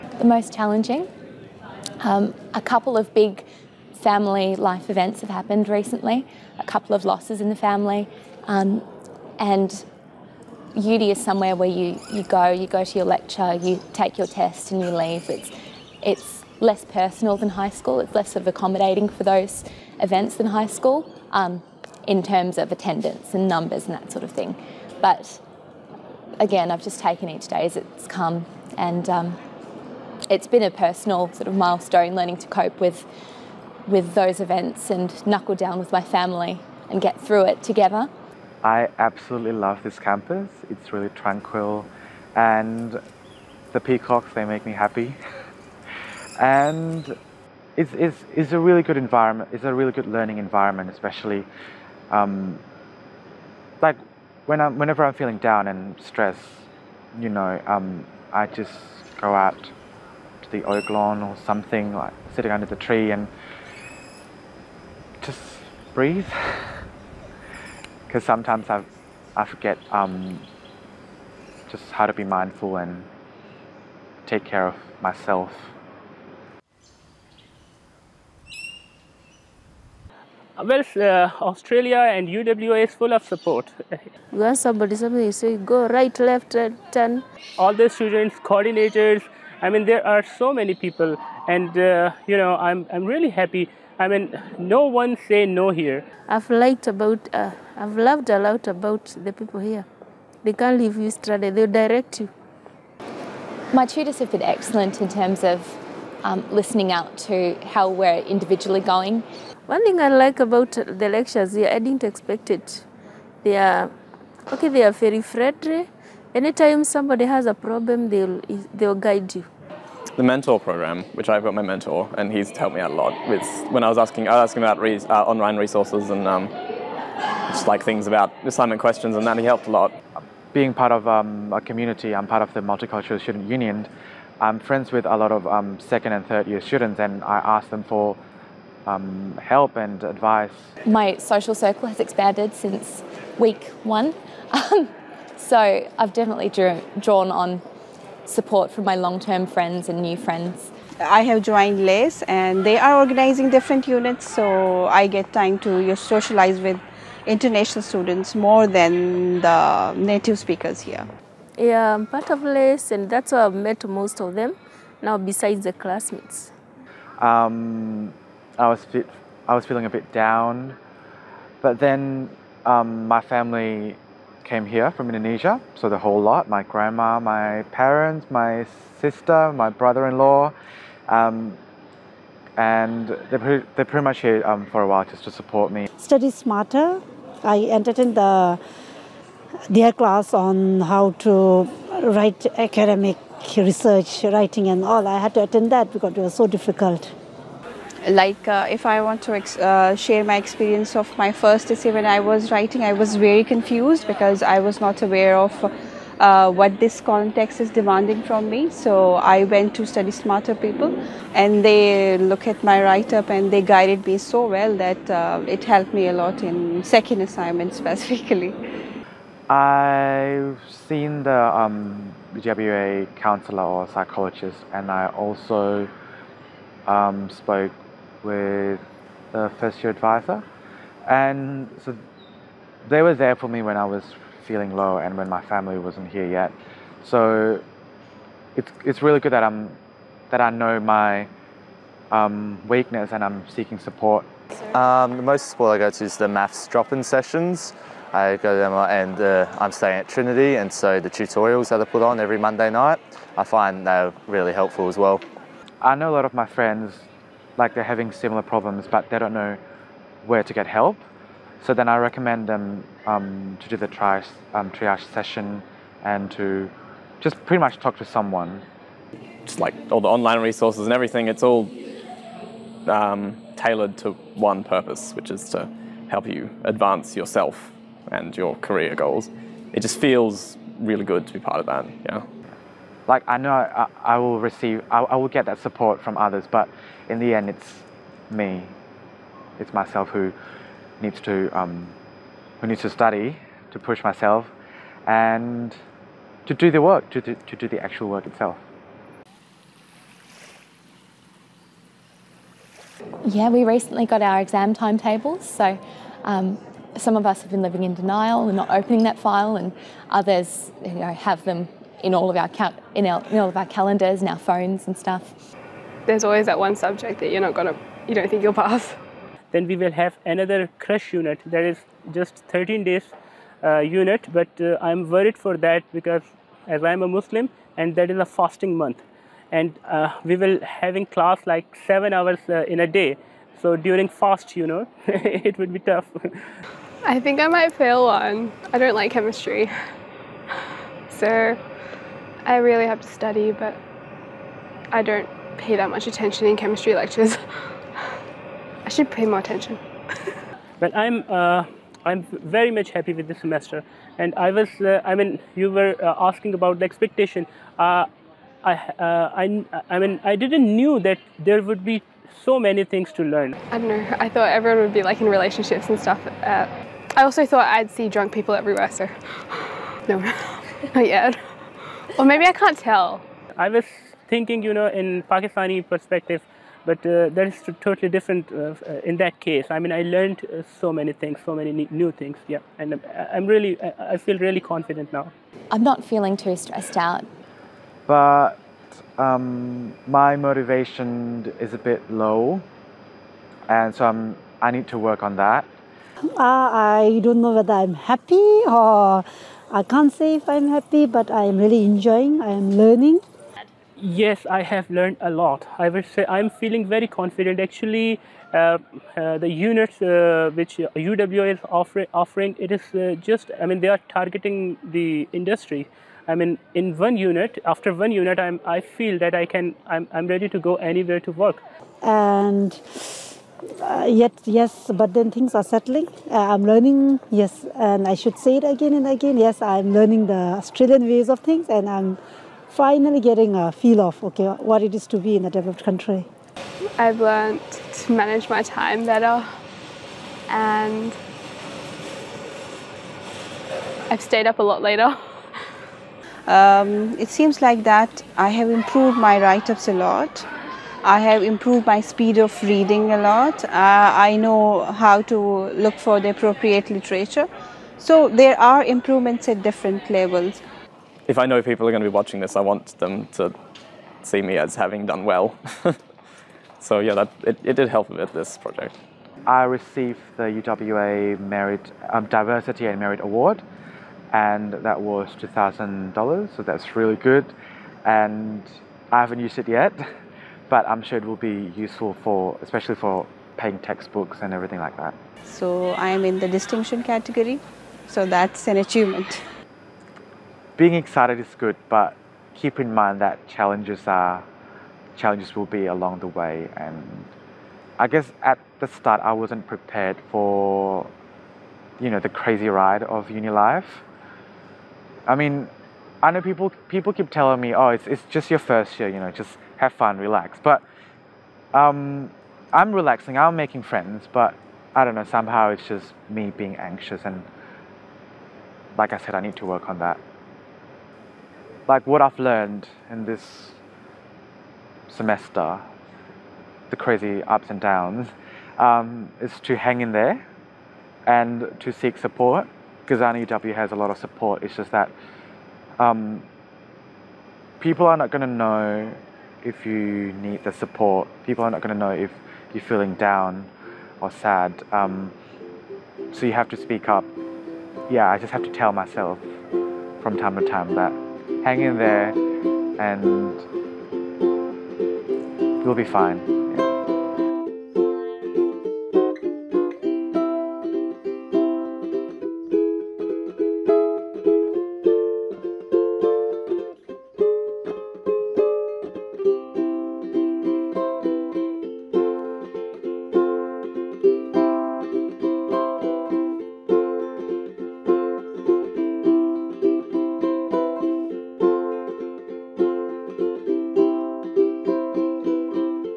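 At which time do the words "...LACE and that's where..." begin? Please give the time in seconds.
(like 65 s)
162 s.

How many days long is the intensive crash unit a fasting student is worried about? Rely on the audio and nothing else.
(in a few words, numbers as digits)
13.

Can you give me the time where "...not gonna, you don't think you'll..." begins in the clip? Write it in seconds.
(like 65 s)
317 s.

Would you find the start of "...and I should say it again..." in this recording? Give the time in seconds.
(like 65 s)
427 s.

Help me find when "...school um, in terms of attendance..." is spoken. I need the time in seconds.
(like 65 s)
20 s.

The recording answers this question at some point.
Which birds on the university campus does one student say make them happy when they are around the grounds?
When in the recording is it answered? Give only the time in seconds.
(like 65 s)
43 s.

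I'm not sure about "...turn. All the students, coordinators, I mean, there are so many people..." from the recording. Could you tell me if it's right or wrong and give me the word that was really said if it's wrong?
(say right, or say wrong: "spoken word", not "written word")
right.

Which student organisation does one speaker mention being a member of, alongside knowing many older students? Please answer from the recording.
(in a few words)
Multicultural Student Union.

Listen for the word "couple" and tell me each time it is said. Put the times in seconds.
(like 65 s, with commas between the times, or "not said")
2 s, 6 s.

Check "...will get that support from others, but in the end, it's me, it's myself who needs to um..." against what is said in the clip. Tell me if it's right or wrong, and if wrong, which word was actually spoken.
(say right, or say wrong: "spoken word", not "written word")
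right.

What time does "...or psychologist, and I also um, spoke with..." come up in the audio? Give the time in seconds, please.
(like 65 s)
223 s.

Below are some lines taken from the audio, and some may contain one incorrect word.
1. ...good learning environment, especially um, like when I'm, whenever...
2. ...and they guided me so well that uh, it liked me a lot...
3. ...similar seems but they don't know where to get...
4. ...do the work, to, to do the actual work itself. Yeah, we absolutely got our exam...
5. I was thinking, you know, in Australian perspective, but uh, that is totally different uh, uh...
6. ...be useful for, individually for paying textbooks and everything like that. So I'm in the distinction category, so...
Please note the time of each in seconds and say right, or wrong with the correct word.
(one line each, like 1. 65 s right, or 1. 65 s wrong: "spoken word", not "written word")
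1. 49 s right
2. 213 s wrong: "helped", not "liked"
3. 258 s wrong: "problems", not "seems"
4. 296 s wrong: "recently", not "absolutely"
5. 373 s wrong: "Pakistani", not "Australian"
6. 481 s wrong: "especially", not "individually".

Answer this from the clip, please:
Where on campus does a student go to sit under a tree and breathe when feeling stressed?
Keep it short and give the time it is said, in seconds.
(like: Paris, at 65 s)
The oak lawn, at 60 s.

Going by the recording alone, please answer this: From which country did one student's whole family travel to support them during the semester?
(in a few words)
Indonesia.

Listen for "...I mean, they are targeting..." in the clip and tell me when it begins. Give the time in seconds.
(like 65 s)
413 s.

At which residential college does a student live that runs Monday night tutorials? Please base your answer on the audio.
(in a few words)
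Trinity.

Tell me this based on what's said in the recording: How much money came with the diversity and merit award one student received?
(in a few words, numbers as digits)
$2,000.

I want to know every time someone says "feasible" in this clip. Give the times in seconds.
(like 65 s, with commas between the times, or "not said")
not said.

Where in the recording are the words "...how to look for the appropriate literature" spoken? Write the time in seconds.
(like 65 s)
454 s.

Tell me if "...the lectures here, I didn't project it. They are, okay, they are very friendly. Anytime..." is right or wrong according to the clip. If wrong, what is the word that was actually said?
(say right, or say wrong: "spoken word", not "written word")
wrong: "expect", not "project".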